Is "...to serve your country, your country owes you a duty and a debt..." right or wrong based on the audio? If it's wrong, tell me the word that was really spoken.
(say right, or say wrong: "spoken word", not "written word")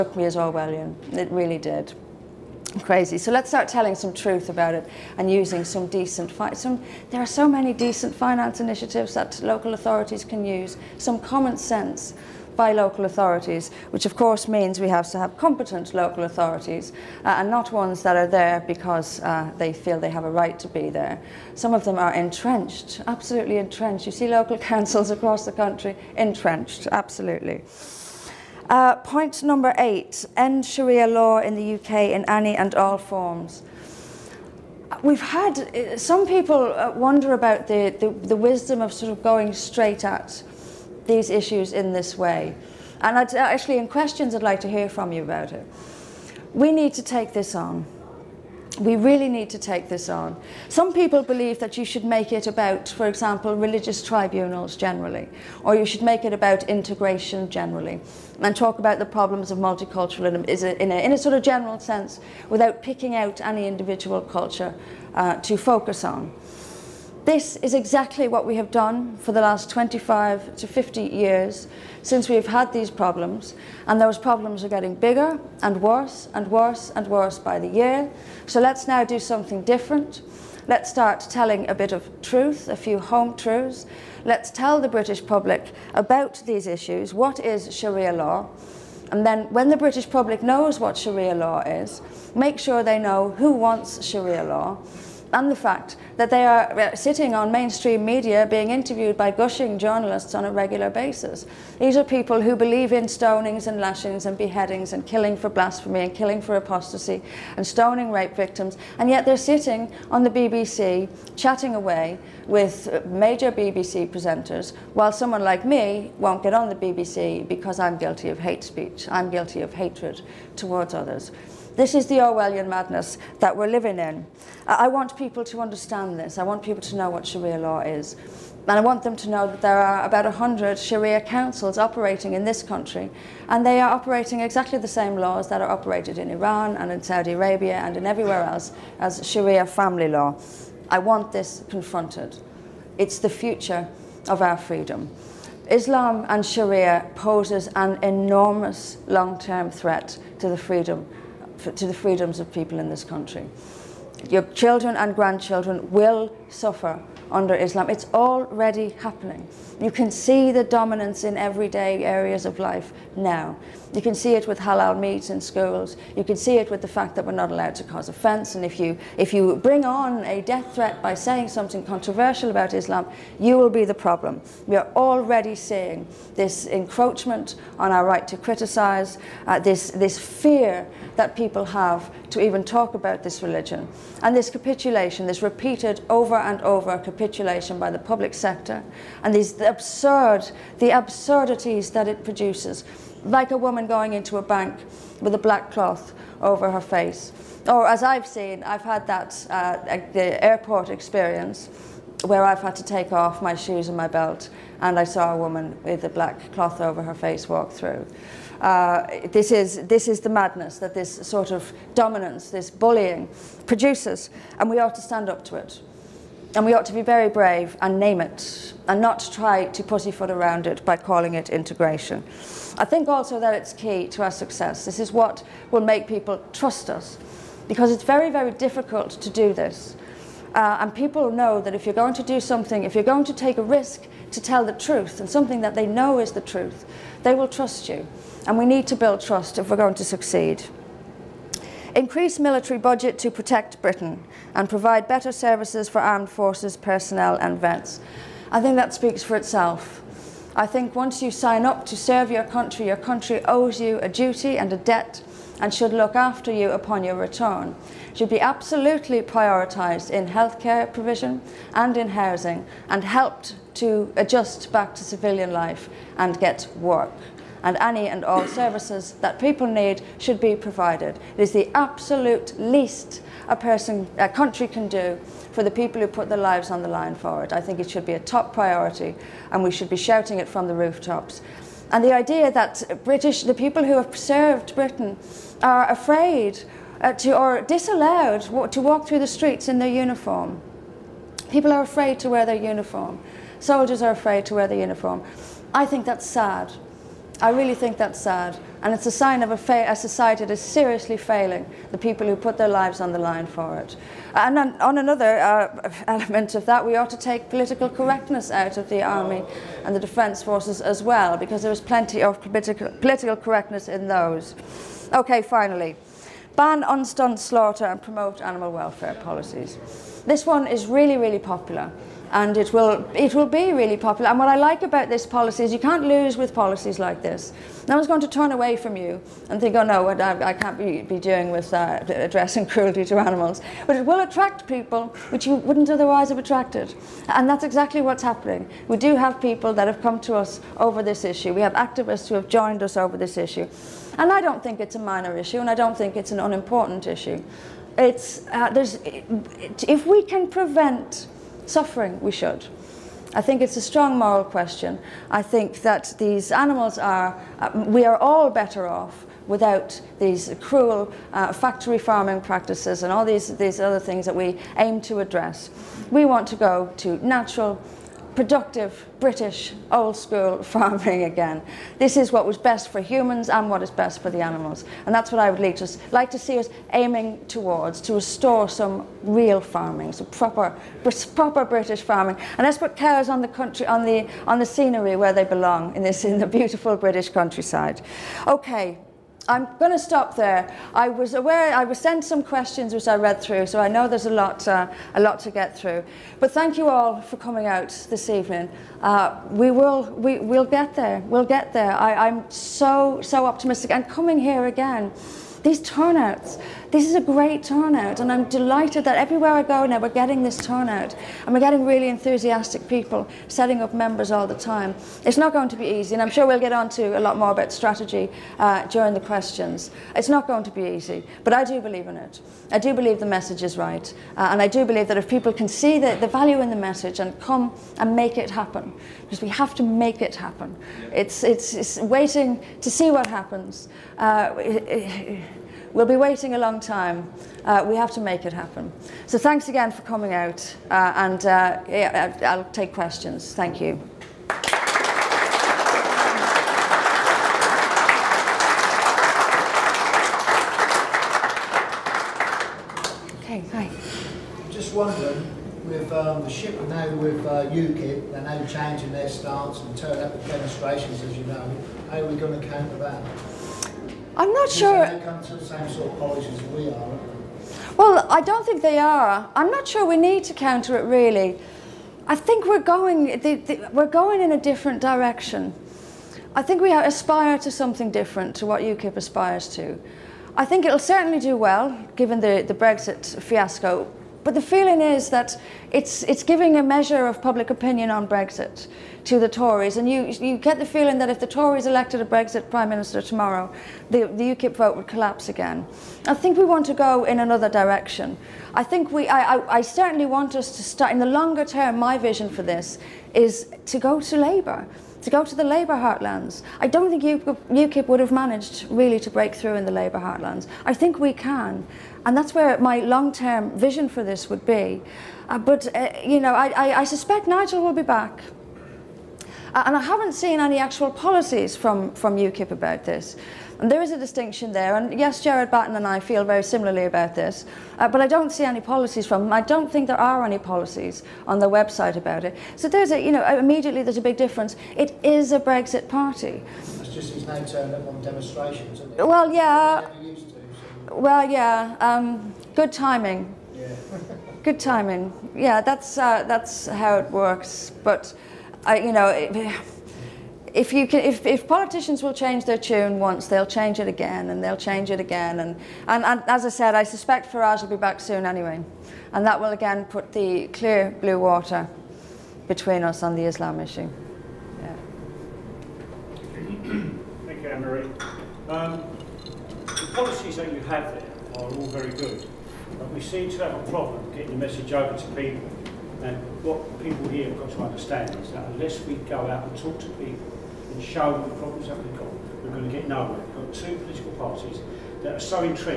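right.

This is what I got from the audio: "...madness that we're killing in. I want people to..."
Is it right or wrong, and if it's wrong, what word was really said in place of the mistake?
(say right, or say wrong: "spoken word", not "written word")
wrong: "living", not "killing".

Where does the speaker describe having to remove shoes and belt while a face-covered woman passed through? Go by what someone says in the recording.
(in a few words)
the airport.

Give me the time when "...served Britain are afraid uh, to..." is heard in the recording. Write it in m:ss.
4:44.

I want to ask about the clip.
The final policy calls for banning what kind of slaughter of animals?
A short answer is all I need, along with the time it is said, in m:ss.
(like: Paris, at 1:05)
unstunned slaughter, at 5:16.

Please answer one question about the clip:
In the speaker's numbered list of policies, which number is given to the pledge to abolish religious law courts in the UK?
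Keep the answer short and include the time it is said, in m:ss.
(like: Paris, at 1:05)
8, at 0:29.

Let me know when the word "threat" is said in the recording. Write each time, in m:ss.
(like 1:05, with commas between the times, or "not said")
2:29, 2:50.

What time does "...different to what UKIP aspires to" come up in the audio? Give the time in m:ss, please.
7:58.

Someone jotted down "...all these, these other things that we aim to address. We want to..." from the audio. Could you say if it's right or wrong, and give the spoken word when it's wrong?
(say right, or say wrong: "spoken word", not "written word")
right.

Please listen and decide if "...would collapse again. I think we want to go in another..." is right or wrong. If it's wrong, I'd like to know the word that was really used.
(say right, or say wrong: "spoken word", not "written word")
right.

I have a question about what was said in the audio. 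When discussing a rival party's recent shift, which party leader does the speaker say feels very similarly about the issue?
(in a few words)
Gerard Batten.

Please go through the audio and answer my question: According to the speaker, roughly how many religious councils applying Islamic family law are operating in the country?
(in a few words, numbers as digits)
100.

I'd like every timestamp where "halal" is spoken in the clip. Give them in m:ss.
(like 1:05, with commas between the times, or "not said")
2:44.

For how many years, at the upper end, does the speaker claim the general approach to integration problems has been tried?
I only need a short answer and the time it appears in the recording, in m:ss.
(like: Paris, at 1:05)
50, at 1:10.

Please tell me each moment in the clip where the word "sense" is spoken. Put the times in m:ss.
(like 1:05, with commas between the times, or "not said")
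0:11, 1:01.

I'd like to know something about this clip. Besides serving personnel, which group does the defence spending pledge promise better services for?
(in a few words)
vets.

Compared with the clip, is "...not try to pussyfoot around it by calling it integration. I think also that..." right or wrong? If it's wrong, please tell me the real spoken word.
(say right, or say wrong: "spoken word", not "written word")
right.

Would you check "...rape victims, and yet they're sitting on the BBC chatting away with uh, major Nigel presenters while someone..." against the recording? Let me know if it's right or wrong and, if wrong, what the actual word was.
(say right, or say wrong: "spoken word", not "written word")
wrong: "BBC", not "Nigel".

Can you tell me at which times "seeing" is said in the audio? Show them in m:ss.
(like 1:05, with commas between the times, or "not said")
2:55.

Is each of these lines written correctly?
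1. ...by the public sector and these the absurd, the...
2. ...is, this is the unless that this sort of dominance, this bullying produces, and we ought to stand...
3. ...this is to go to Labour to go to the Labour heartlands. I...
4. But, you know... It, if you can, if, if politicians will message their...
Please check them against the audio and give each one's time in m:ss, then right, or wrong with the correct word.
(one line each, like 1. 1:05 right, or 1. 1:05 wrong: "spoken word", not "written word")
1. 3:07 right
2. 3:29 wrong: "madness", not "unless"
3. 8:22 right
4. 9:08 wrong: "change", not "message".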